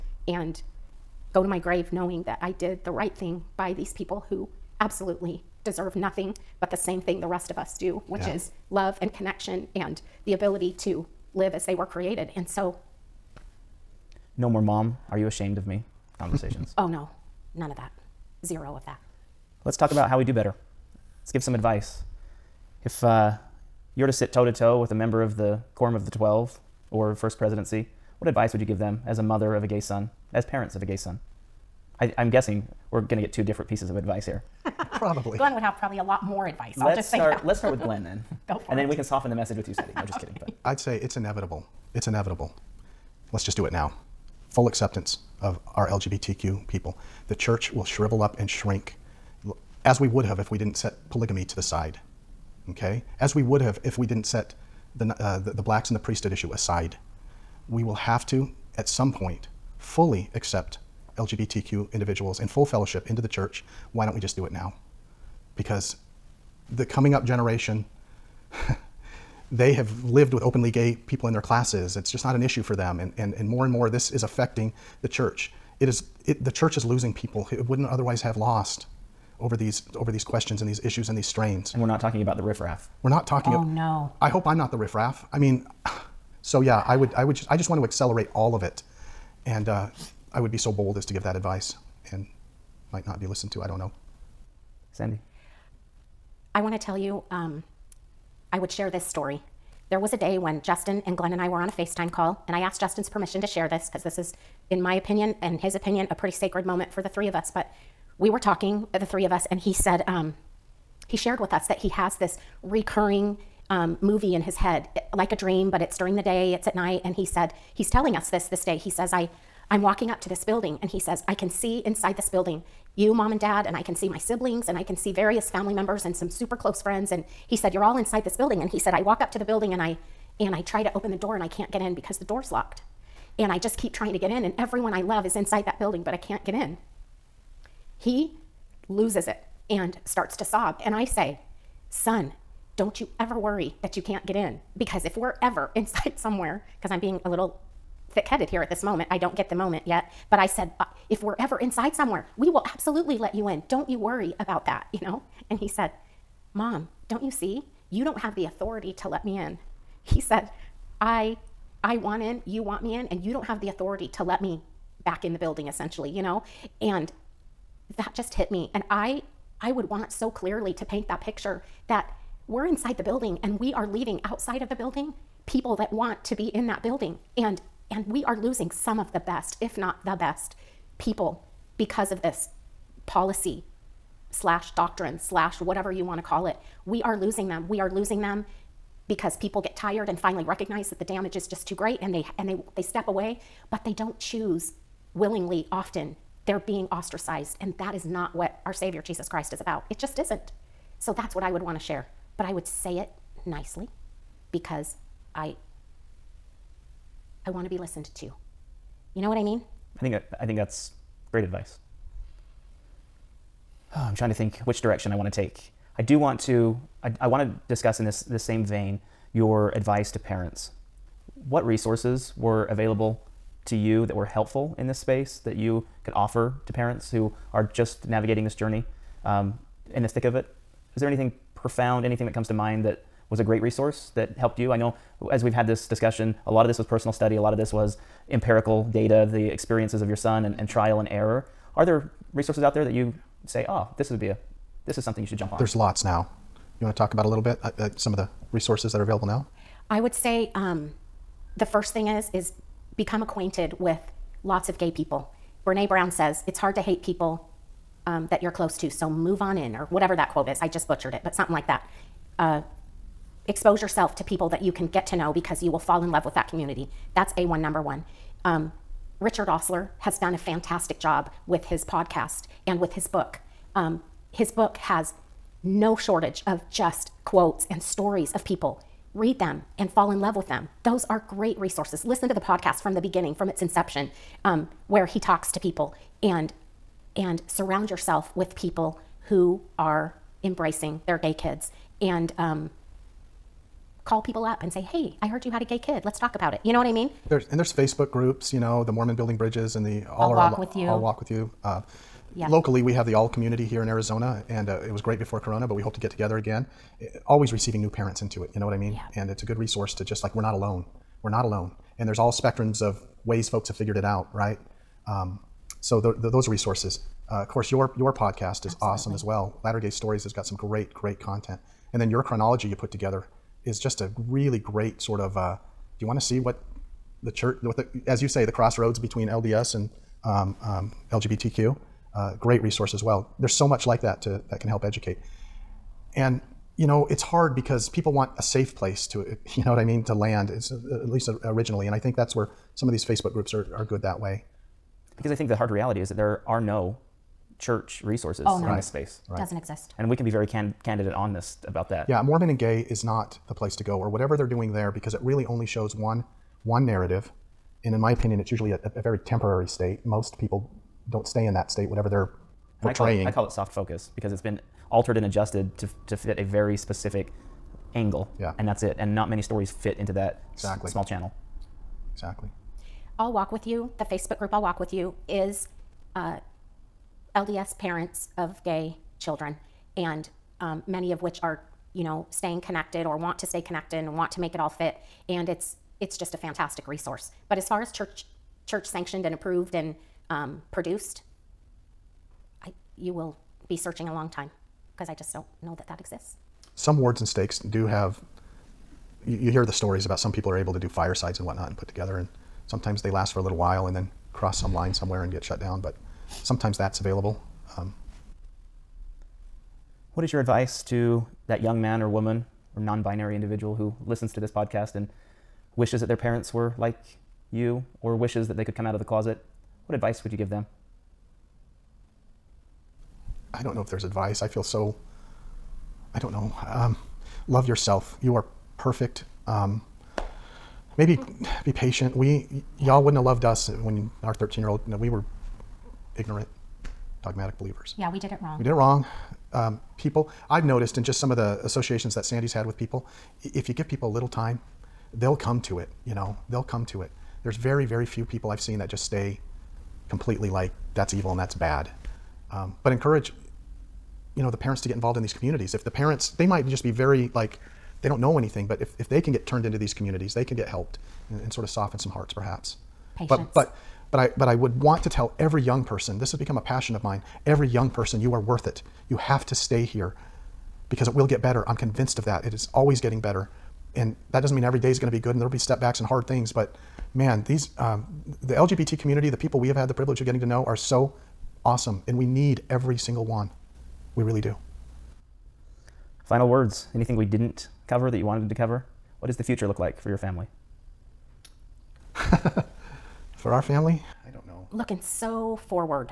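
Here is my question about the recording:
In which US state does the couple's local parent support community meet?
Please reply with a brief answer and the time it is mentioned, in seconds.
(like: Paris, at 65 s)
Arizona, at 303 s.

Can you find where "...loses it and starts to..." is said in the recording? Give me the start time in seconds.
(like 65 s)
138 s.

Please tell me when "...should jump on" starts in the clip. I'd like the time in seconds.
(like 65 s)
245 s.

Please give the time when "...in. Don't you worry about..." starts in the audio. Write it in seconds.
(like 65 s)
153 s.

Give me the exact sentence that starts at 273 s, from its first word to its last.
Um, his book has no shortage of just quotes and stories of people.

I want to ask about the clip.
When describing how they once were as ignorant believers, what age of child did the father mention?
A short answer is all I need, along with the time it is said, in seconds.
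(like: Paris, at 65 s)
13, at 434 s.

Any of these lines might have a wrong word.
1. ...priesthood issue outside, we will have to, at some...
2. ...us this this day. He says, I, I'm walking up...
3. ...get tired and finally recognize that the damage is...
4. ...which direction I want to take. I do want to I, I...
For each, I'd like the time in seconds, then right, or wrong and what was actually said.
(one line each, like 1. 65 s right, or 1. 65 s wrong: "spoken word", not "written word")
1. 55 s wrong: "aside", not "outside"
2. 118 s right
3. 189 s right
4. 214 s right.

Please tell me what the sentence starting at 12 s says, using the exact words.
And so no more mom, are you ashamed of me conversations.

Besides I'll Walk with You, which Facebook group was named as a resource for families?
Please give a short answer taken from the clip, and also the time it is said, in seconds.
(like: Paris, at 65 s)
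Mormon Building Bridges, at 298 s.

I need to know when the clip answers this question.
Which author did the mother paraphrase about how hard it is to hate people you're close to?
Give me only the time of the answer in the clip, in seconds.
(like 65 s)
255 s.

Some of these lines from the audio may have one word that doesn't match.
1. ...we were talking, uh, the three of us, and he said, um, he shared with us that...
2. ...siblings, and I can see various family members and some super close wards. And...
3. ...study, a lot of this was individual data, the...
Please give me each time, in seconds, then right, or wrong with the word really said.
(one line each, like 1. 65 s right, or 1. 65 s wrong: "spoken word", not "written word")
1. 108 s right
2. 124 s wrong: "friends", not "wards"
3. 237 s wrong: "empirical", not "individual".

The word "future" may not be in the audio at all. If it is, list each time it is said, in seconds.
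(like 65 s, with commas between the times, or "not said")
489 s.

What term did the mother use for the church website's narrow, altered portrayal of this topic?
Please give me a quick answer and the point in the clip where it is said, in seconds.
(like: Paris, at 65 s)
soft focus, at 363 s.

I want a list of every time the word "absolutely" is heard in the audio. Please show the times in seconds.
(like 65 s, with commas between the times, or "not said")
4 s, 152 s, 318 s.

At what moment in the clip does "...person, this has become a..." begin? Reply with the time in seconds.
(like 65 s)
465 s.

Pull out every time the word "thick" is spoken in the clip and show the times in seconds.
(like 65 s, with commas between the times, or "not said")
148 s, 230 s.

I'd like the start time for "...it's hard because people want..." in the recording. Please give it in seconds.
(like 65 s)
337 s.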